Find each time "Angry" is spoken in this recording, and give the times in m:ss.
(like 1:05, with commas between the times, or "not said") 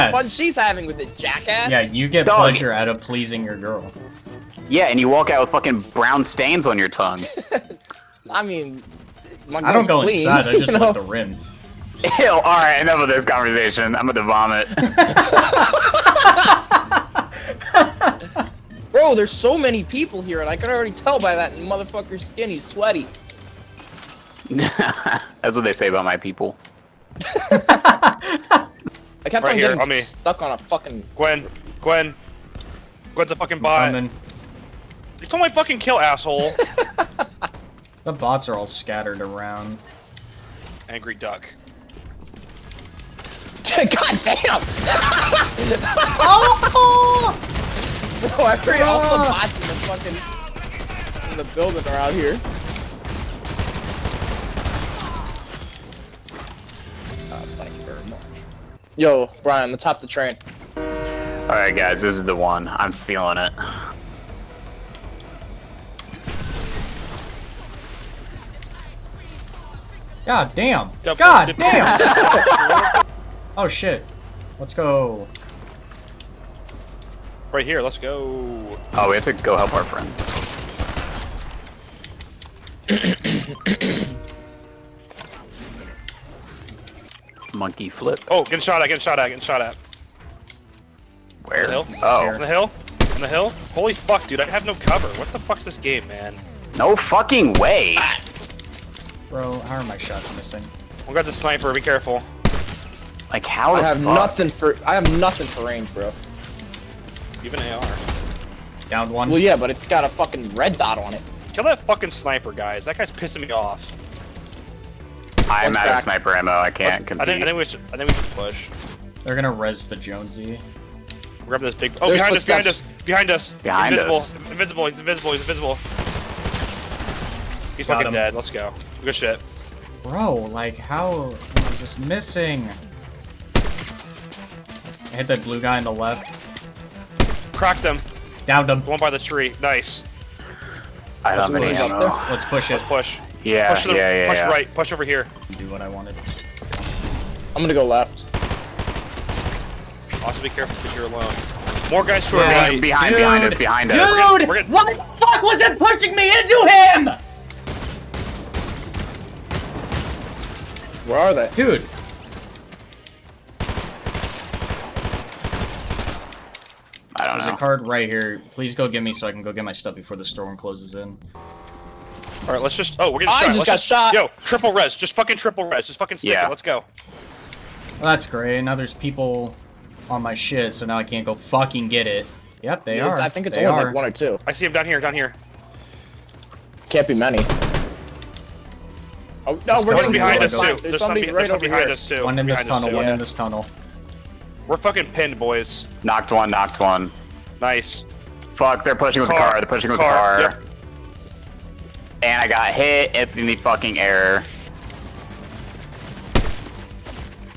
0:40.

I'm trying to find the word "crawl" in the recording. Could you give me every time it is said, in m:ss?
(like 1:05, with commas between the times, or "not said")
not said.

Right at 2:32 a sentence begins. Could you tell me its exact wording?
Behind, behind us, behind Dude, us.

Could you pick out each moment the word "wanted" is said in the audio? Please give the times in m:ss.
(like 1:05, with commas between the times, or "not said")
2:25.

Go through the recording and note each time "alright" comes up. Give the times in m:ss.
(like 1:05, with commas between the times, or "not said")
0:12, 1:00.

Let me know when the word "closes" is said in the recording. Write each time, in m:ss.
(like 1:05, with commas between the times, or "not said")
2:50.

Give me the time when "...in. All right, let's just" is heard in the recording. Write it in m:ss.
2:50.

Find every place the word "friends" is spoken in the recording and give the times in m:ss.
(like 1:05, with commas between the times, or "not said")
1:19.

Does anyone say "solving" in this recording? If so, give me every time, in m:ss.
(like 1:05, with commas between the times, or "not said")
not said.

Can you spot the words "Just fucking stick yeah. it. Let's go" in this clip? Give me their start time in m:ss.
2:55.